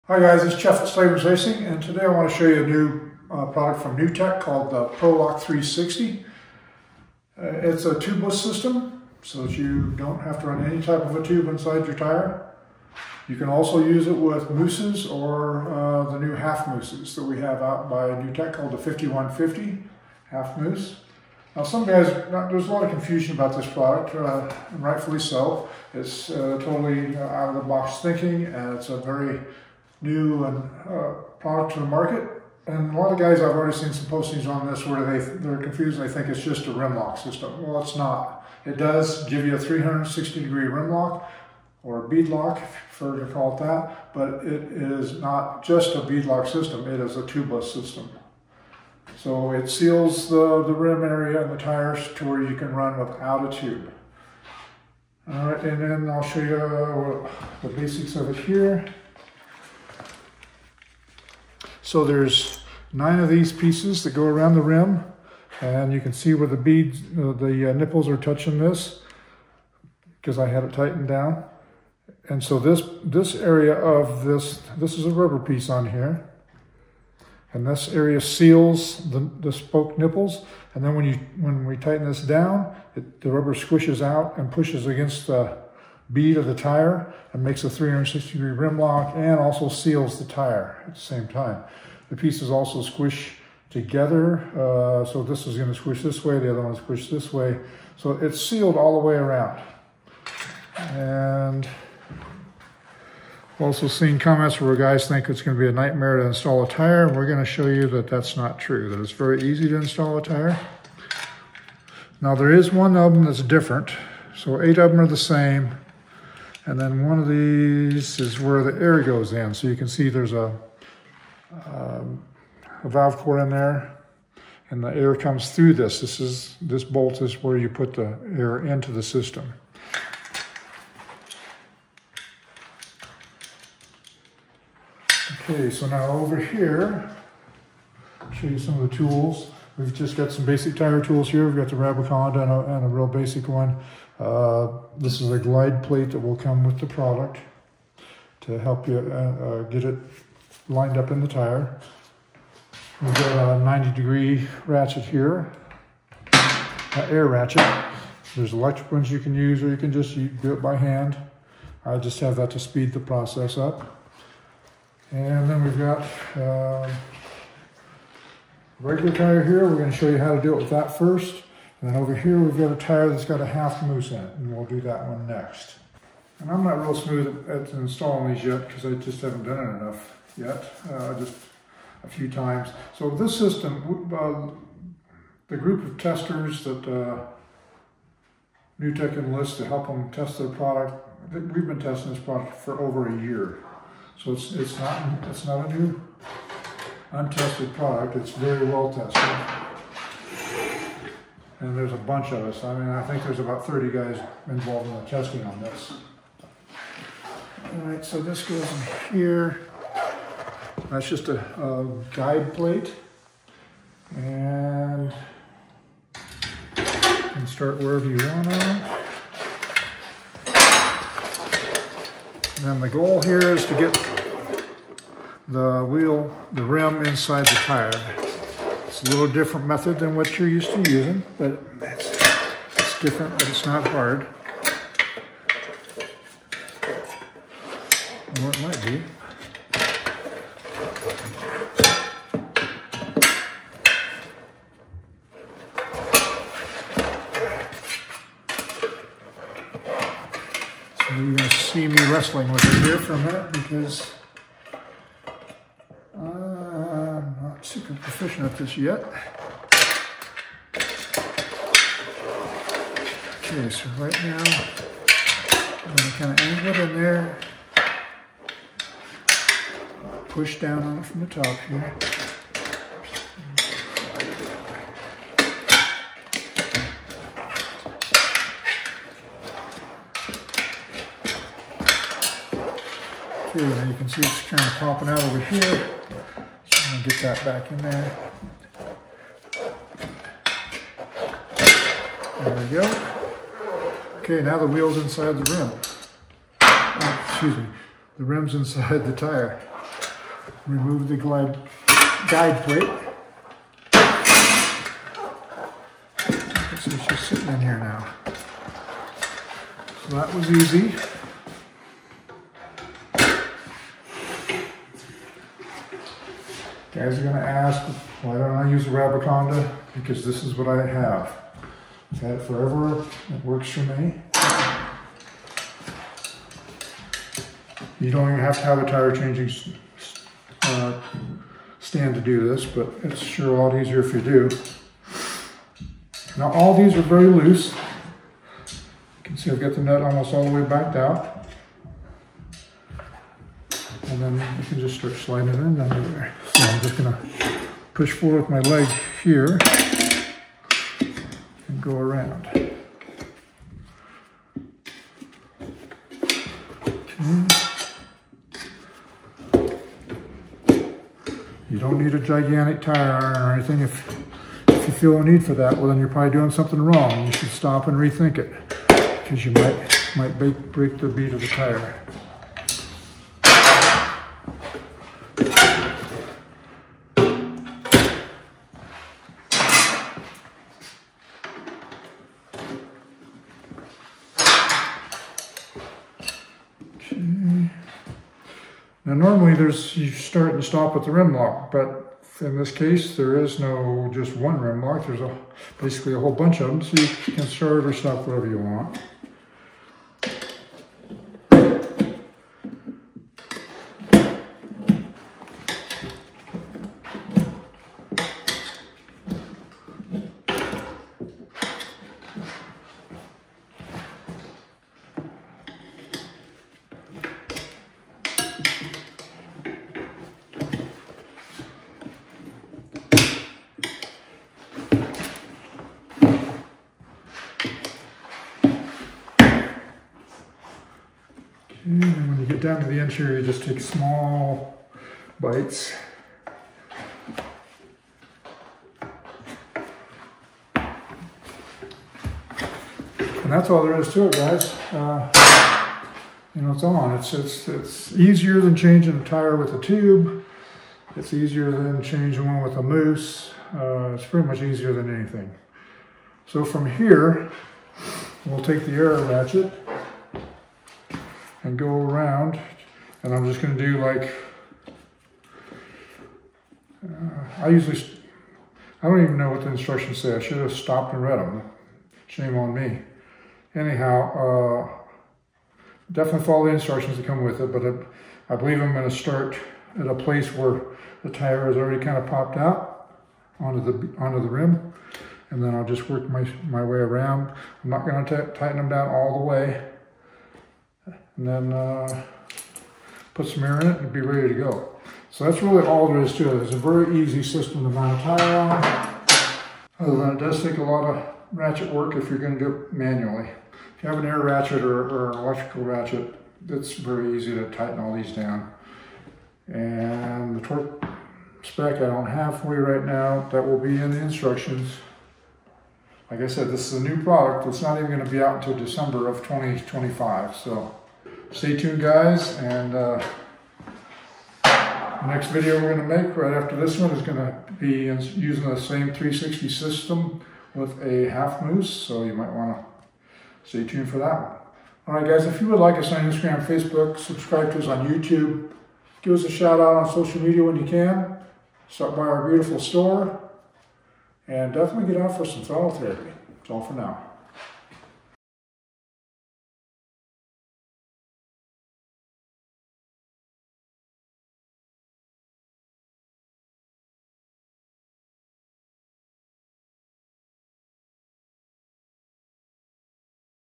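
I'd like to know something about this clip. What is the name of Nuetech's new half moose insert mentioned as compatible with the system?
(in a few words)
5150 half moose.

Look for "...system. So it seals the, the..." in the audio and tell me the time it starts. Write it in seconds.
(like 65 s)
47 s.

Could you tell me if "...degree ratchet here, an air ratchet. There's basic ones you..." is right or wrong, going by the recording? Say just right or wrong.
wrong.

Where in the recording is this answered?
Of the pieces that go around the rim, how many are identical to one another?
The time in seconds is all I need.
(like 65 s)
114 s.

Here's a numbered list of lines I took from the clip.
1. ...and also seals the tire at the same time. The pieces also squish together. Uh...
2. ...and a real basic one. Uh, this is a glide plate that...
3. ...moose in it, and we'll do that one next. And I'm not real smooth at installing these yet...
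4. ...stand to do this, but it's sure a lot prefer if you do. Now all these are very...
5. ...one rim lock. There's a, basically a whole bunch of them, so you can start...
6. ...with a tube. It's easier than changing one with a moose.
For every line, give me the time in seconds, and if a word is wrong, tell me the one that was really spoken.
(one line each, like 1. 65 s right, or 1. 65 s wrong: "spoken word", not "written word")
1. 89 s right
2. 142 s right
3. 173 s right
4. 331 s wrong: "easier", not "prefer"
5. 394 s right
6. 449 s right.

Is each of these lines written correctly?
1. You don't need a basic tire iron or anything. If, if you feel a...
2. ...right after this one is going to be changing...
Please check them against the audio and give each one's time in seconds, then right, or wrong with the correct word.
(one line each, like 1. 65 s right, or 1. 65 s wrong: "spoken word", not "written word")
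1. 361 s wrong: "gigantic", not "basic"
2. 526 s wrong: "using", not "changing".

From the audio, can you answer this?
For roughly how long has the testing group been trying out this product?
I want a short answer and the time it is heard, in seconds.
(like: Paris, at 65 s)
Over a year, at 192 s.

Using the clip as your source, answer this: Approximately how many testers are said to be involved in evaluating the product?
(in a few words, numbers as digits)
About 30.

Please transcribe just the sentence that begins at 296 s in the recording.
Oh, excuse me, the rim's inside the tire.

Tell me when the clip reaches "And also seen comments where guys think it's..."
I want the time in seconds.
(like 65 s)
100 s.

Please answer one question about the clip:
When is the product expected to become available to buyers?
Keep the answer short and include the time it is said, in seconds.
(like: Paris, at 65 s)
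December 2025, at 518 s.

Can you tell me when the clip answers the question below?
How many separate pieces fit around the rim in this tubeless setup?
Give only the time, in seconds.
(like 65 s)
62 s.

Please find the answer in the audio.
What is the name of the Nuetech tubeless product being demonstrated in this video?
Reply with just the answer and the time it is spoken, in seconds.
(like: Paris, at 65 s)
ProLock 360, at 4 s.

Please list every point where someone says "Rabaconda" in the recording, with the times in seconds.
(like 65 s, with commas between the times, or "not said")
141 s, 318 s.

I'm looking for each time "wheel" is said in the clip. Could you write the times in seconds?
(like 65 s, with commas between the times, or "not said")
225 s, 294 s.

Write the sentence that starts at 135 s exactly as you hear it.
Okay, so now over here, I'll show you some of the tools.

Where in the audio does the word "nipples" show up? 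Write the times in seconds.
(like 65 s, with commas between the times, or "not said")
67 s, 79 s.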